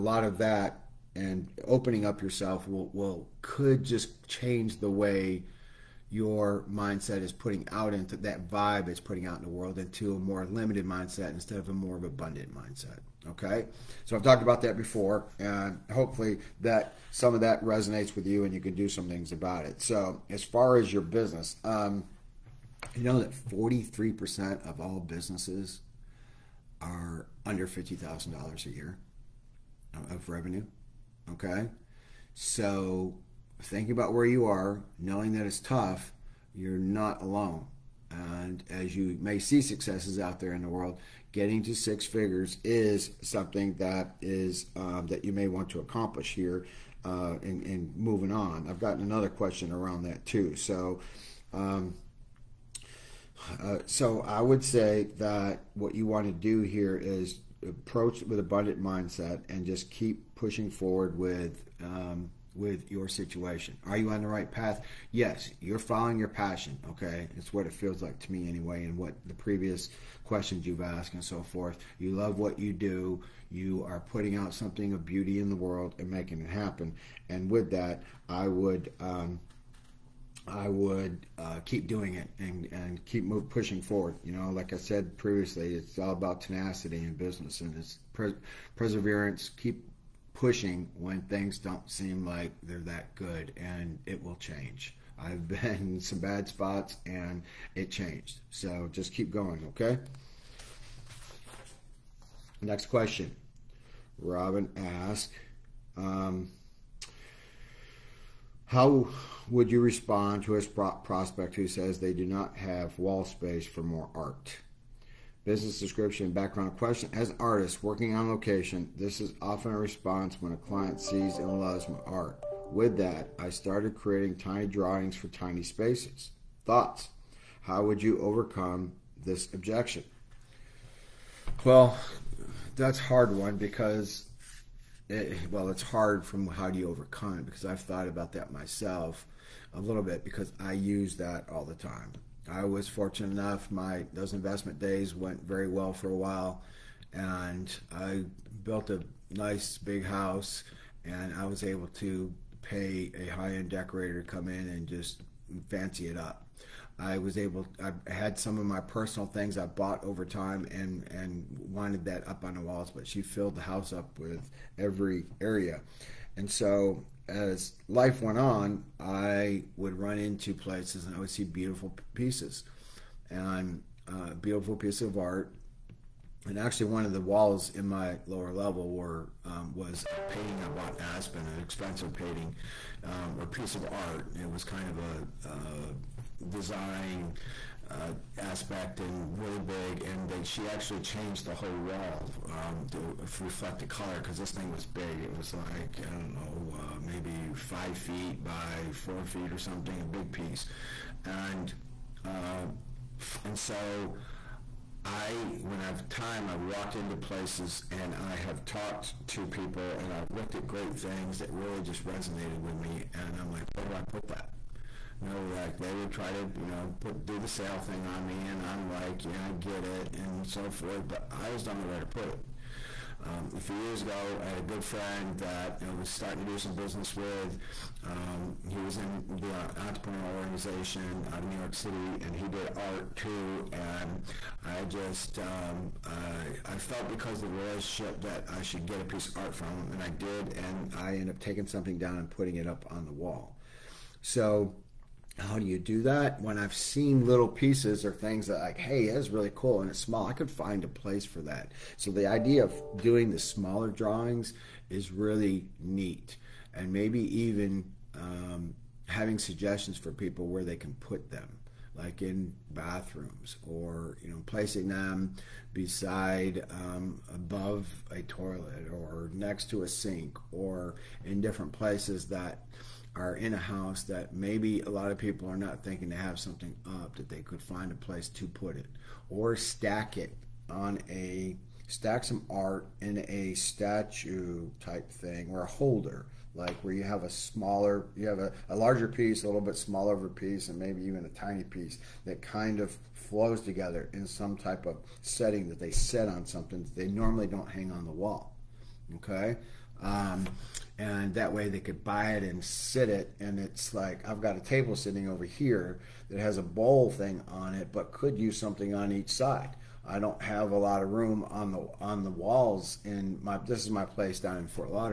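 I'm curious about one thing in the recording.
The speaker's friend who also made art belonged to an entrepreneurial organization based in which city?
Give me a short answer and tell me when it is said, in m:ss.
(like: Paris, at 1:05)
New York City, at 3:51.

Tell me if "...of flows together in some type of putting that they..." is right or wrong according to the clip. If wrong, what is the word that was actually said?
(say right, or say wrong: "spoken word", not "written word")
wrong: "setting", not "putting".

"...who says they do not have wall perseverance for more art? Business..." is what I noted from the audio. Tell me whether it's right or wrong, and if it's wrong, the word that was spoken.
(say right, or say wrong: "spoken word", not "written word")
wrong: "space", not "perseverance".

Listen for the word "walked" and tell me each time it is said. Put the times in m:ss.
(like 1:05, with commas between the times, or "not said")
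3:26.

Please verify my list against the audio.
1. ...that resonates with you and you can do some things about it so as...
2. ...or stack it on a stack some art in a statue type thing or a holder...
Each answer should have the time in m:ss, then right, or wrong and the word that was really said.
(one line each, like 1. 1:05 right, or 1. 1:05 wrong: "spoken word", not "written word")
1. 0:17 right
2. 4:39 right.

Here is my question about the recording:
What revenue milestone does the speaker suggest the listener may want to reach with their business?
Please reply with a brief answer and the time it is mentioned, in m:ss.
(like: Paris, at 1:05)
six figures, at 0:41.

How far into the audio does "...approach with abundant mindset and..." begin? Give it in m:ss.
0:57.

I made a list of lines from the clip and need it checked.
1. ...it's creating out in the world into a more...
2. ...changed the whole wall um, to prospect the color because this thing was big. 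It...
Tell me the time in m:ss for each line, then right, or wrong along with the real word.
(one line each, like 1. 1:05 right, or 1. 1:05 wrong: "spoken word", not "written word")
1. 0:08 wrong: "putting", not "creating"
2. 3:11 wrong: "reflect", not "prospect".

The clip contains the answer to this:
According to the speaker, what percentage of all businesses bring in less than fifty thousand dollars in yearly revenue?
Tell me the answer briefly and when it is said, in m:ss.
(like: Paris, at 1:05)
43%, at 0:23.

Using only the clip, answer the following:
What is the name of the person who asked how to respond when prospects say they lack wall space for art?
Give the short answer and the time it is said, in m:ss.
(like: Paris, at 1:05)
Robin, at 1:44.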